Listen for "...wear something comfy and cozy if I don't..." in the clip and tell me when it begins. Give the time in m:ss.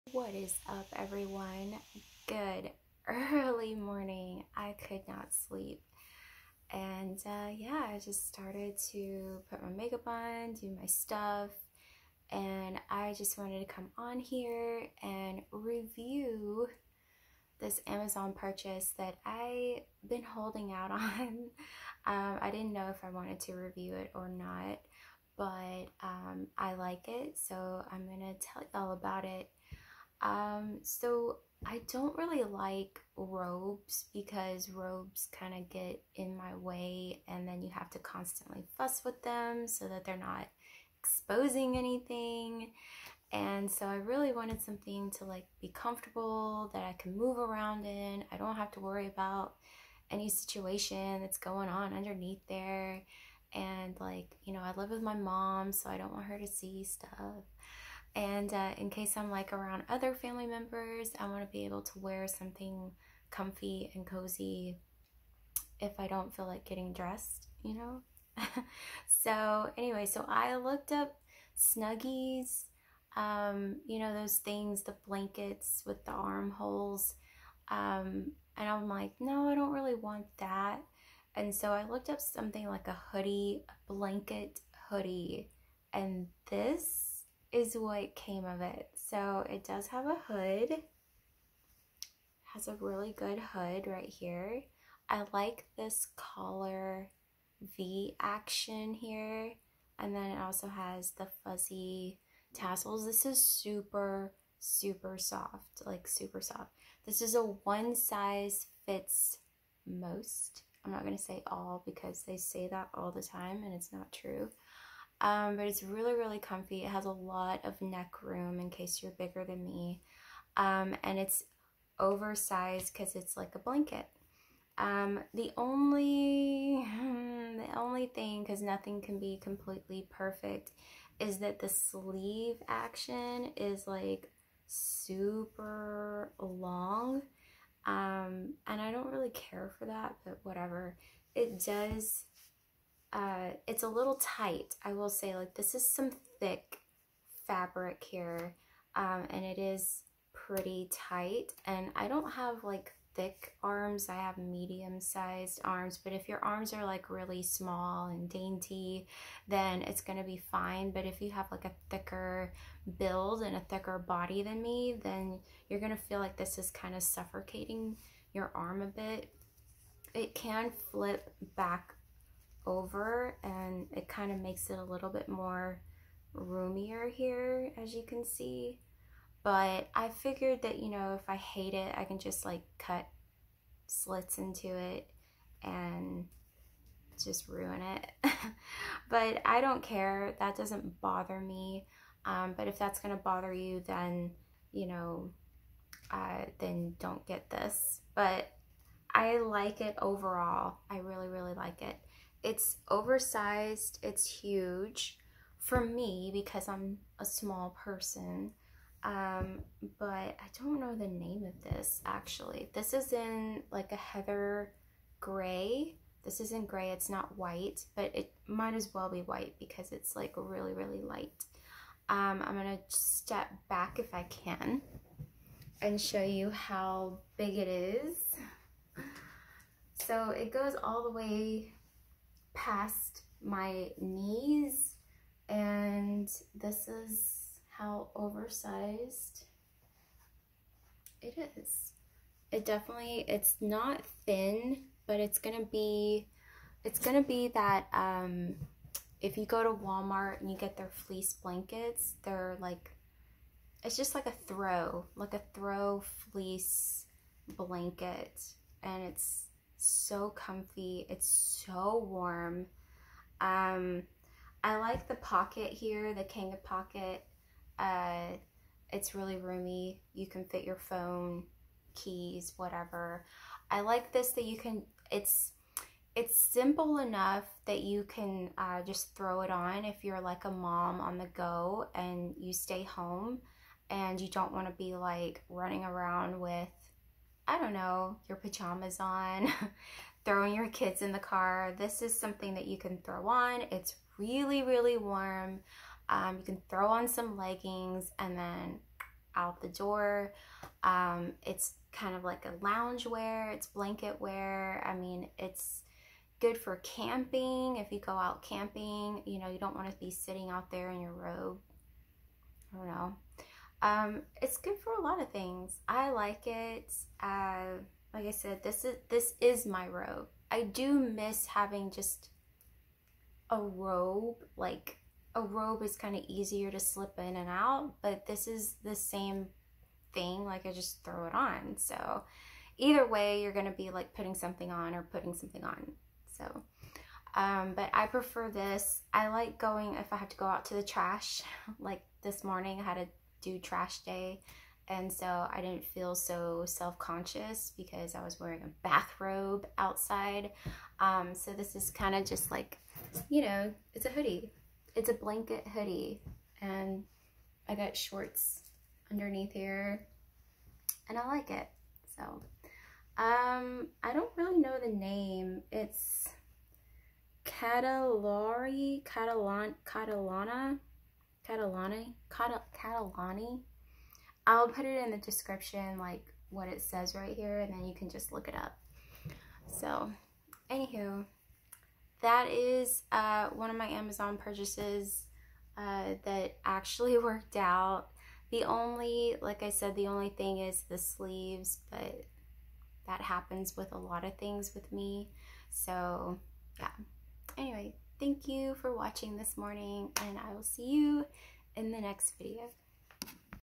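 1:01.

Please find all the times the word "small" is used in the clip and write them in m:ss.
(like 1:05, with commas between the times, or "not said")
2:37, 3:27.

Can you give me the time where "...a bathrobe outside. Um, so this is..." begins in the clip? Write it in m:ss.
5:48.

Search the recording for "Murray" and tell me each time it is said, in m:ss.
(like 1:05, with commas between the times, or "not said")
not said.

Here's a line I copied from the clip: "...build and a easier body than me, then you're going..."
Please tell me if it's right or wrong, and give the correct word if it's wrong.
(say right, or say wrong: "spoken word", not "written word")
wrong: "thicker", not "easier".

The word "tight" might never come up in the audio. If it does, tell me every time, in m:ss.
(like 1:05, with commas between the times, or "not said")
2:24, 2:30.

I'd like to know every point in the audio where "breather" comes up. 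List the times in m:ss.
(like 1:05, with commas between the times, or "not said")
not said.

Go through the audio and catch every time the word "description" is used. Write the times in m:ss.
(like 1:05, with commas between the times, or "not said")
6:15.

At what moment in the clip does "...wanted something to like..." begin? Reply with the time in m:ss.
0:44.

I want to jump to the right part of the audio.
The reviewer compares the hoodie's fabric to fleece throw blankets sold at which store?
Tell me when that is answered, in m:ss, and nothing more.
4:09.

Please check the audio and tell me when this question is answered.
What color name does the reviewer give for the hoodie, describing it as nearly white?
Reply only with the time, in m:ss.
3:33.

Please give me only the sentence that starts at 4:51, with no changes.
This is something that you can throw on.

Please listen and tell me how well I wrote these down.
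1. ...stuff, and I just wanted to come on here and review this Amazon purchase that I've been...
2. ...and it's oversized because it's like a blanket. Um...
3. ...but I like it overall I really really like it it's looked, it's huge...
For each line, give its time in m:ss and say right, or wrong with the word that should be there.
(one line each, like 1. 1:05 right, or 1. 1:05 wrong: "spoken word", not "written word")
1. 0:10 right
2. 2:01 right
3. 3:18 wrong: "oversized", not "looked".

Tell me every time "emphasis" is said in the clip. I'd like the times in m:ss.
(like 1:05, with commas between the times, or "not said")
not said.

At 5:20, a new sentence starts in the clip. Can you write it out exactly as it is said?
I do miss having just a robe.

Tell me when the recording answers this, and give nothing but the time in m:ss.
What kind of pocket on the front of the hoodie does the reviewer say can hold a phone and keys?
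4:26.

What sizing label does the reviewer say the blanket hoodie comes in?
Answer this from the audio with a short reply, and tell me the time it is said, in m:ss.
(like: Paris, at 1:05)
one size fits most, at 1:47.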